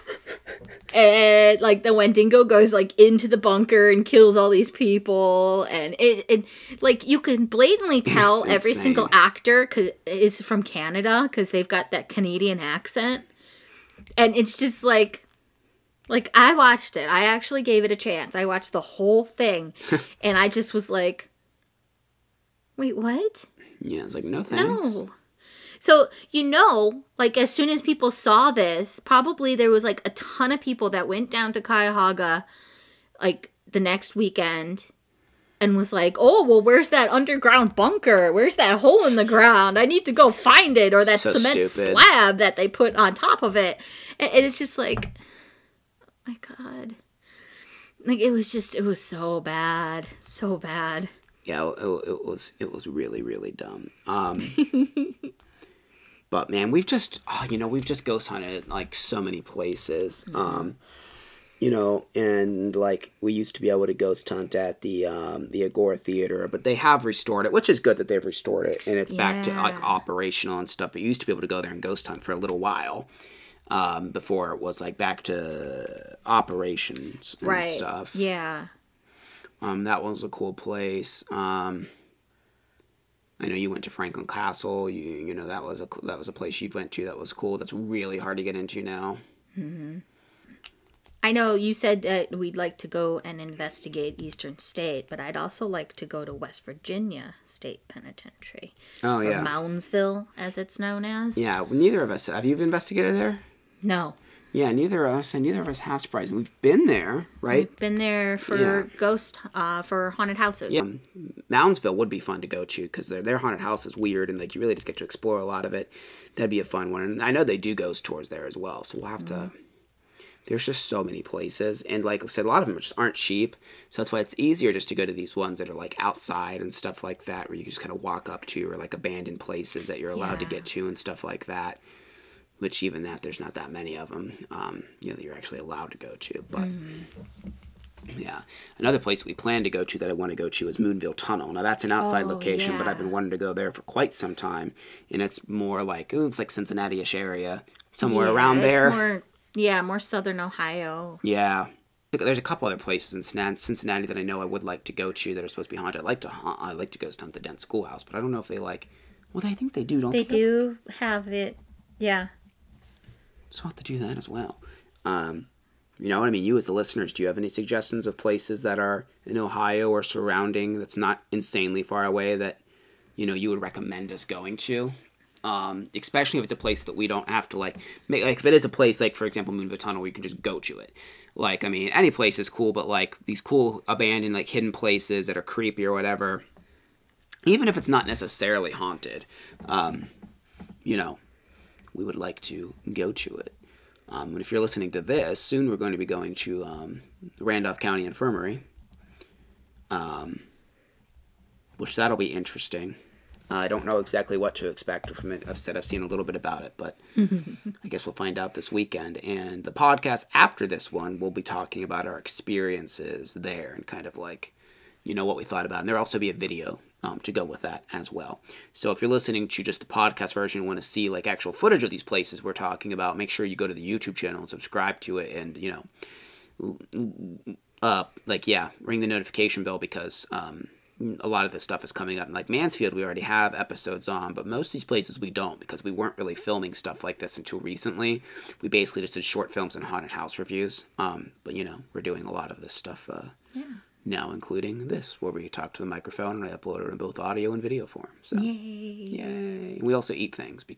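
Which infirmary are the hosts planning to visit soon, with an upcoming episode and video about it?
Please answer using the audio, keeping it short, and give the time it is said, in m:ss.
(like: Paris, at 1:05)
Randolph County Infirmary, at 3:17.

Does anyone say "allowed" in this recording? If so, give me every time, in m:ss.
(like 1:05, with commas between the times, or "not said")
2:10, 2:15.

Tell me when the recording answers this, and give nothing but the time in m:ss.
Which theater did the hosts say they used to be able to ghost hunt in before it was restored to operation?
1:05.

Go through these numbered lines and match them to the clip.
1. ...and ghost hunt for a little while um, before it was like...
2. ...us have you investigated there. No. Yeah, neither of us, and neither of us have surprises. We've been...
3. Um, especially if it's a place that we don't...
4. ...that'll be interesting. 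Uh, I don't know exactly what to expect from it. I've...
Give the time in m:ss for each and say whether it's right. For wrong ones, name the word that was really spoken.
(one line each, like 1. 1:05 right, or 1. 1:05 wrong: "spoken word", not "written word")
1. 1:11 right
2. 1:42 right
3. 2:55 right
4. 3:21 right.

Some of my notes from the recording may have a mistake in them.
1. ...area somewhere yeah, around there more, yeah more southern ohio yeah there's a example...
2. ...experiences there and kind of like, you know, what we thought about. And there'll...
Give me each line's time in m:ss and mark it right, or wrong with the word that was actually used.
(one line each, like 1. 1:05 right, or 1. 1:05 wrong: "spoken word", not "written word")
1. 2:27 wrong: "couple", not "example"
2. 3:32 right.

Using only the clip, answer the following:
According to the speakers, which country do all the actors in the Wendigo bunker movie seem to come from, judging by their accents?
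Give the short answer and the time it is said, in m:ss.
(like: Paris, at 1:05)
Canada, at 0:10.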